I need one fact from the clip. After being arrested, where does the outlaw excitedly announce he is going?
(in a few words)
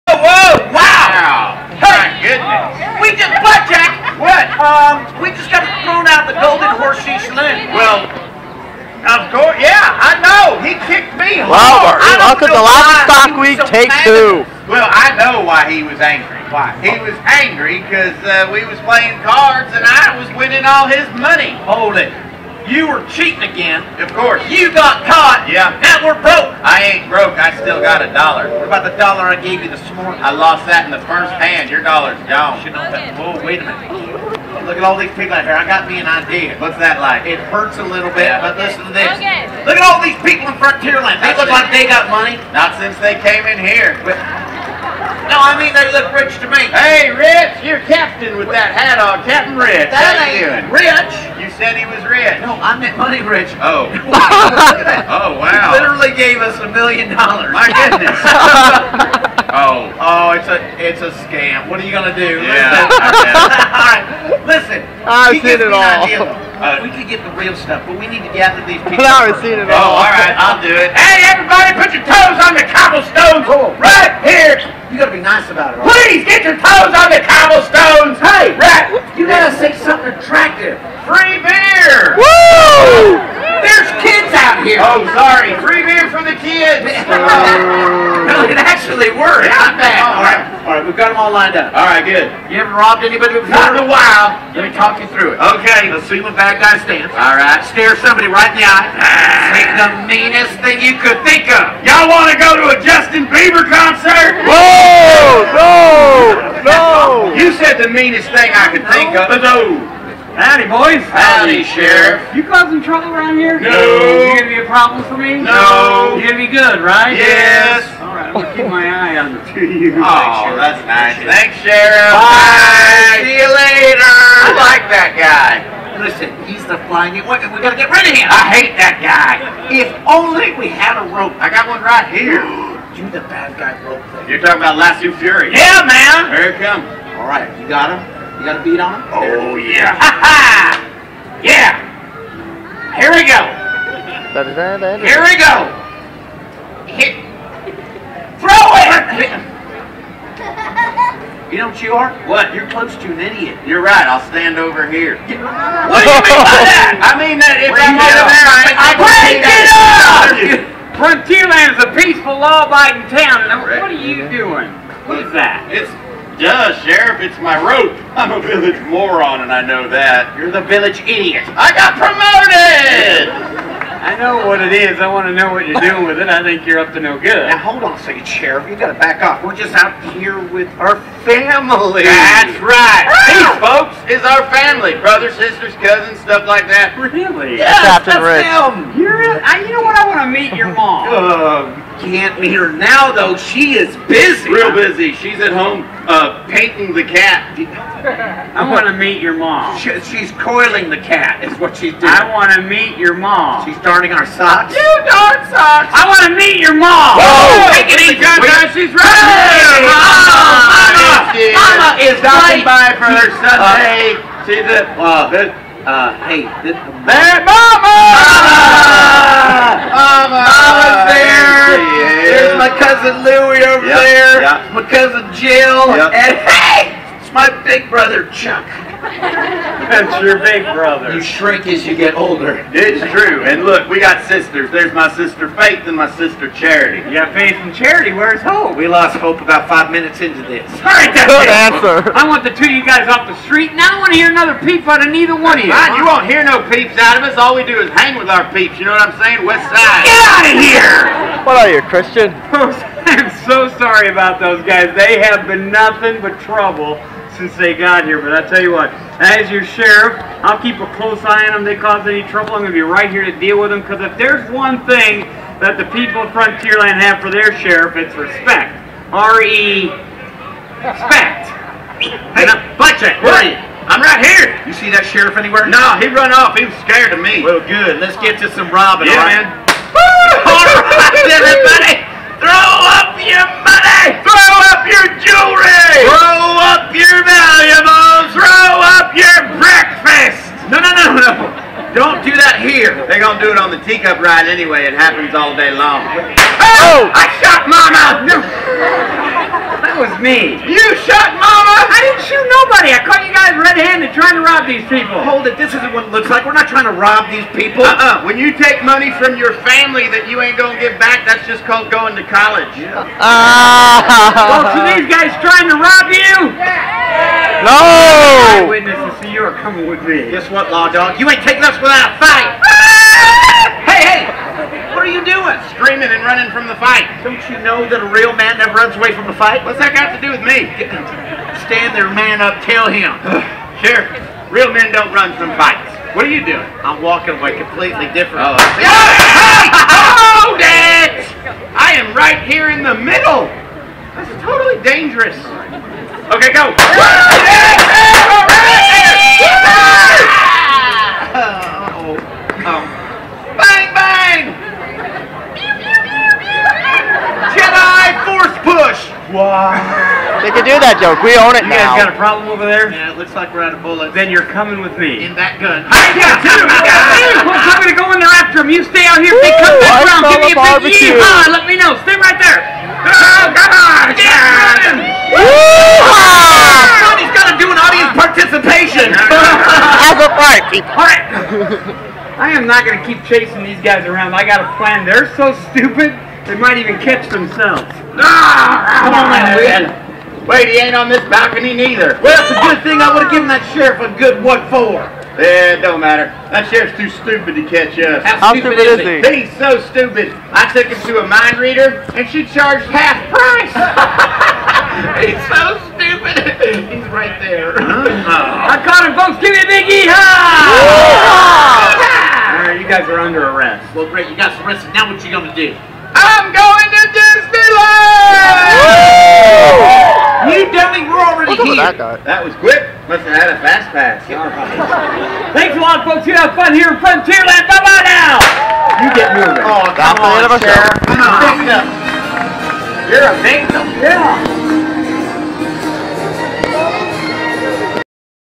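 Disneyland.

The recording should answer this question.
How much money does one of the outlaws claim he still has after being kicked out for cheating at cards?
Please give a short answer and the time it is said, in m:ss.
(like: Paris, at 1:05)
$1, at 0:28.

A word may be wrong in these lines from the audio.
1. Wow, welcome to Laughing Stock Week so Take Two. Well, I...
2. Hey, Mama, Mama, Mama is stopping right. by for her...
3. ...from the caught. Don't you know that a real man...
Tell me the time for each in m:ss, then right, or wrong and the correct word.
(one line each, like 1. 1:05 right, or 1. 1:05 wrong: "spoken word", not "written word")
1. 0:11 right
2. 3:29 right
3. 5:26 wrong: "fight", not "caught".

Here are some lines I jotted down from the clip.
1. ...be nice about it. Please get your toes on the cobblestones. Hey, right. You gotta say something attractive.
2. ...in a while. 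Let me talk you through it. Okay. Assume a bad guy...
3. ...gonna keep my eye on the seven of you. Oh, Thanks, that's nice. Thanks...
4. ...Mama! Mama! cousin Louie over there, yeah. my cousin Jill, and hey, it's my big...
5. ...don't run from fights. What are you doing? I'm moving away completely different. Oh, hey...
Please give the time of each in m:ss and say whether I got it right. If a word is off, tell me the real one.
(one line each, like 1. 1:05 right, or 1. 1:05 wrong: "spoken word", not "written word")
1. 1:15 right
2. 1:33 right
3. 1:58 wrong: "two", not "seven"
4. 3:37 right
5. 5:34 wrong: "walking", not "moving".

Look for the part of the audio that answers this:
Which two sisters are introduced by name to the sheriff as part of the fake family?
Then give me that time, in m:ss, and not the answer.
3:55.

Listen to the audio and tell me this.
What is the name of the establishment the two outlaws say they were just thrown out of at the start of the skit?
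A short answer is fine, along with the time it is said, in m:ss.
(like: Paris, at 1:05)
Golden Horseshoe, at 0:06.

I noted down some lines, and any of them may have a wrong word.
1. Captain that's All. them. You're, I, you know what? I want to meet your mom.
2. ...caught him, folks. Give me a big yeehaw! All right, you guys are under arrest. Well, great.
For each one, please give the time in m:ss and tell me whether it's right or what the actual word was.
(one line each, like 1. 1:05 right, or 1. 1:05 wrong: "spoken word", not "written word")
1. 3:07 wrong: "Rick", not "All"
2. 6:48 right.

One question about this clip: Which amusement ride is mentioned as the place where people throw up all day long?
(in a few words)
teacup ride.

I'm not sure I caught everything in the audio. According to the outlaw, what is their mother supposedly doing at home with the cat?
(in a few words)
painting the cat.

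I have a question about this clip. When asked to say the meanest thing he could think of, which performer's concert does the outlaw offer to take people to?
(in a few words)
Justin Bieber.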